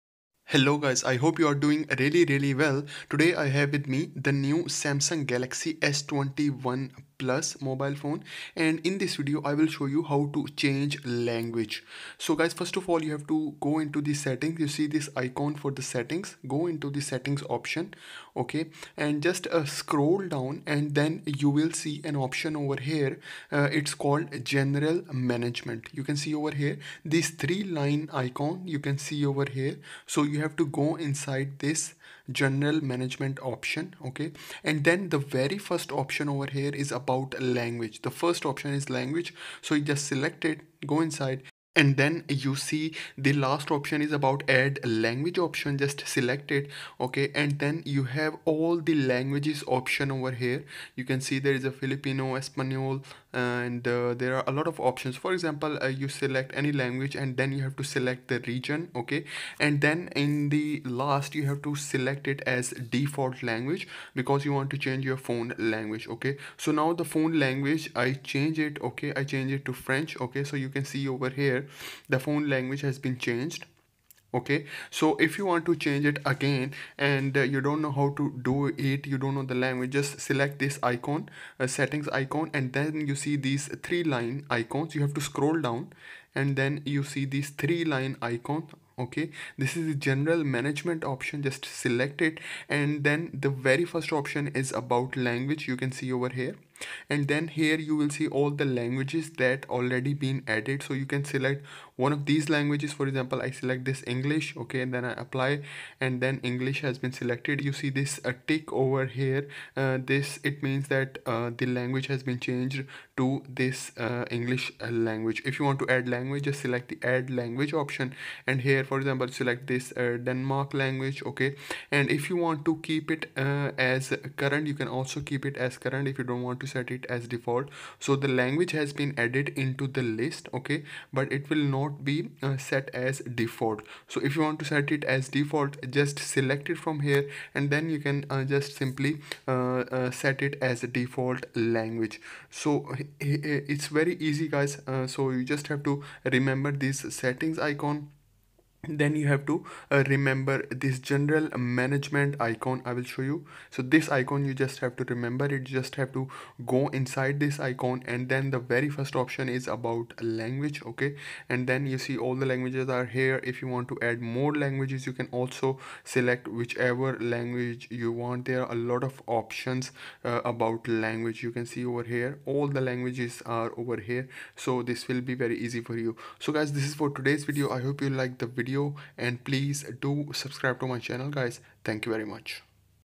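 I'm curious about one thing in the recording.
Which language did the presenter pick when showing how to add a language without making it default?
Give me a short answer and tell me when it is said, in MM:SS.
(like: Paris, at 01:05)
Denmark language, at 01:59.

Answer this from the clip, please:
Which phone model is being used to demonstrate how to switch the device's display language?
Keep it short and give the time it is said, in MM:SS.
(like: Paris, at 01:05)
Samsung Galaxy S21 Plus, at 00:04.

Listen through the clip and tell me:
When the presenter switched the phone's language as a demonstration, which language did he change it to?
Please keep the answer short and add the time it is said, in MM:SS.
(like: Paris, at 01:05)
French, at 01:09.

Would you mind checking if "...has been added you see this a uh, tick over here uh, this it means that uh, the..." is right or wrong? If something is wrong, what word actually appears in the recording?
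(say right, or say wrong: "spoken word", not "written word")
wrong: "selected", not "added".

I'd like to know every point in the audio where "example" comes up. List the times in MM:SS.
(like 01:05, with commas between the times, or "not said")
00:55, 01:43, 01:58.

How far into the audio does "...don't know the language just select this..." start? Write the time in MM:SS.
01:19.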